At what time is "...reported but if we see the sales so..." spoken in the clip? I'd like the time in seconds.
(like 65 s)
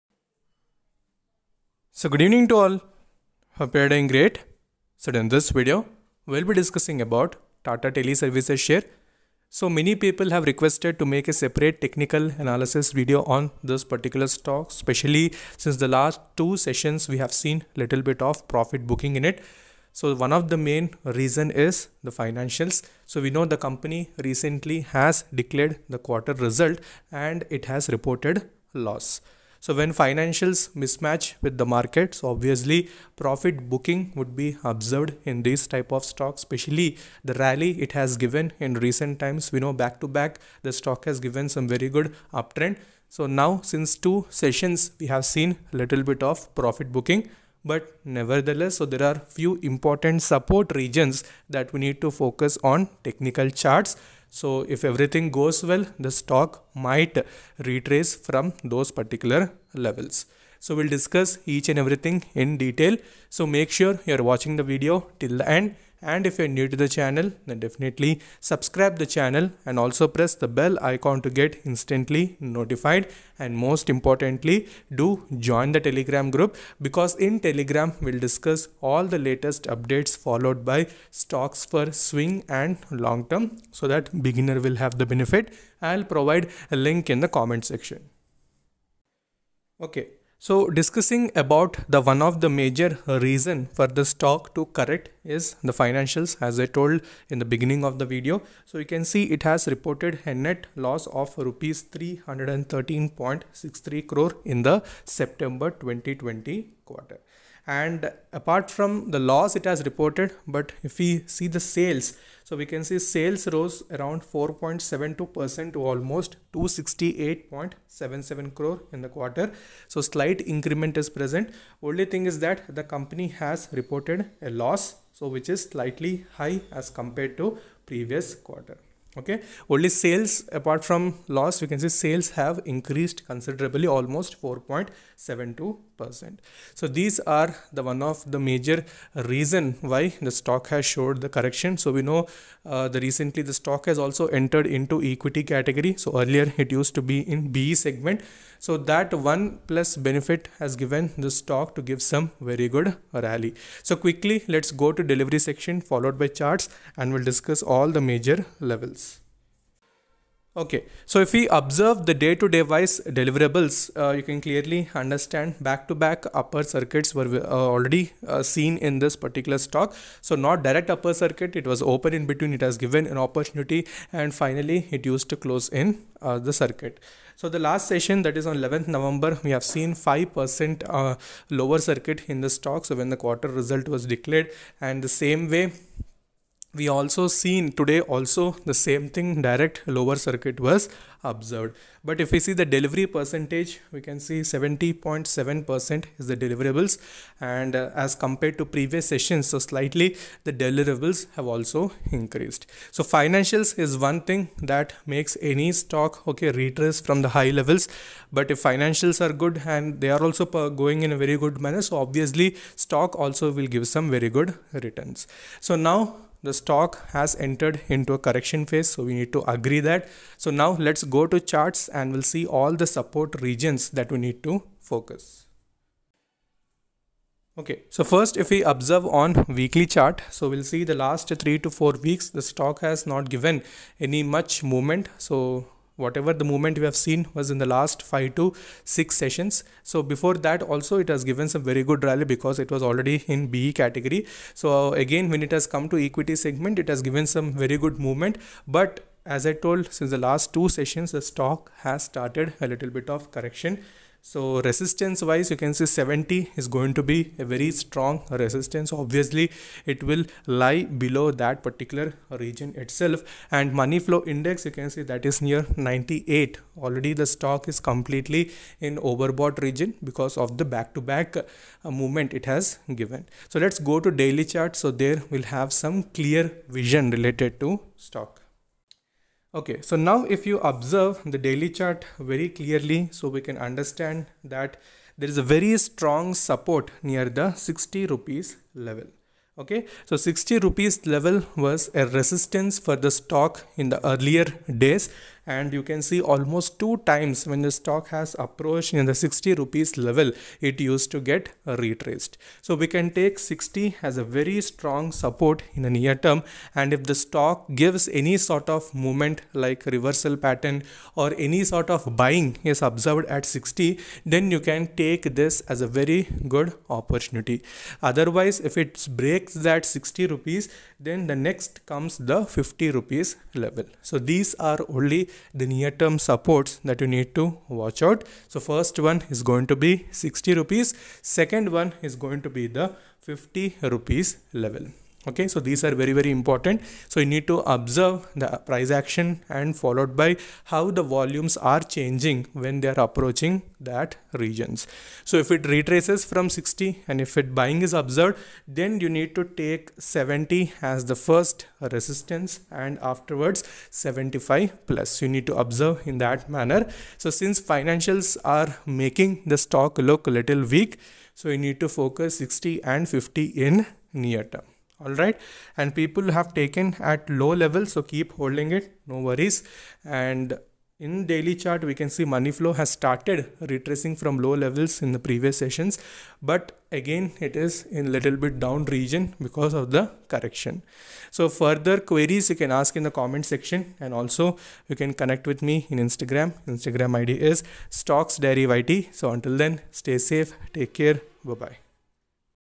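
109 s.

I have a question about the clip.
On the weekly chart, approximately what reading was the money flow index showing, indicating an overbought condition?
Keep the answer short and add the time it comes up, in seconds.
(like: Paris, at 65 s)
98, at 265 s.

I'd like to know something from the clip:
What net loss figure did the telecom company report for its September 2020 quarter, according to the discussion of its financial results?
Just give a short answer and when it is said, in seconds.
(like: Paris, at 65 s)
Rs 313.63 crore, at 101 s.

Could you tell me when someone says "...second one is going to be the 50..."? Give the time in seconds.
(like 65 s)
331 s.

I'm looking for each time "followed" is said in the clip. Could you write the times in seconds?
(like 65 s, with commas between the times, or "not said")
80 s, 155 s, 339 s.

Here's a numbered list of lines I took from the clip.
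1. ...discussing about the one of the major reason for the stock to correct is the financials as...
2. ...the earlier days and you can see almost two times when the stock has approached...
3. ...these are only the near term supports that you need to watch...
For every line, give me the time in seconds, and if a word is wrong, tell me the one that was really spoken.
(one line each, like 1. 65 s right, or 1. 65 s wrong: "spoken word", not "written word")
1. 90 s right
2. 293 s right
3. 324 s right.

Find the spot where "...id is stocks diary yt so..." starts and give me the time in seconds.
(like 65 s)
387 s.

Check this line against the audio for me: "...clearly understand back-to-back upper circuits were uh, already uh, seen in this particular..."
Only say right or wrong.
right.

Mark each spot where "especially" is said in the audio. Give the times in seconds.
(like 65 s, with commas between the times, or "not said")
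14 s, 36 s.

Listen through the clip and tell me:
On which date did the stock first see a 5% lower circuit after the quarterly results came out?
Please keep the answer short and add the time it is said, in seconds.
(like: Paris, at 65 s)
11 November, at 178 s.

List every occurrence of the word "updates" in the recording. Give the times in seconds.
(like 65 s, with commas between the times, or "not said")
79 s.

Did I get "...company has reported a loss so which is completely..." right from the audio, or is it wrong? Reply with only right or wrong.
wrong.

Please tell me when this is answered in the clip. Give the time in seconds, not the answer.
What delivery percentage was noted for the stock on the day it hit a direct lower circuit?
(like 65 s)
194 s.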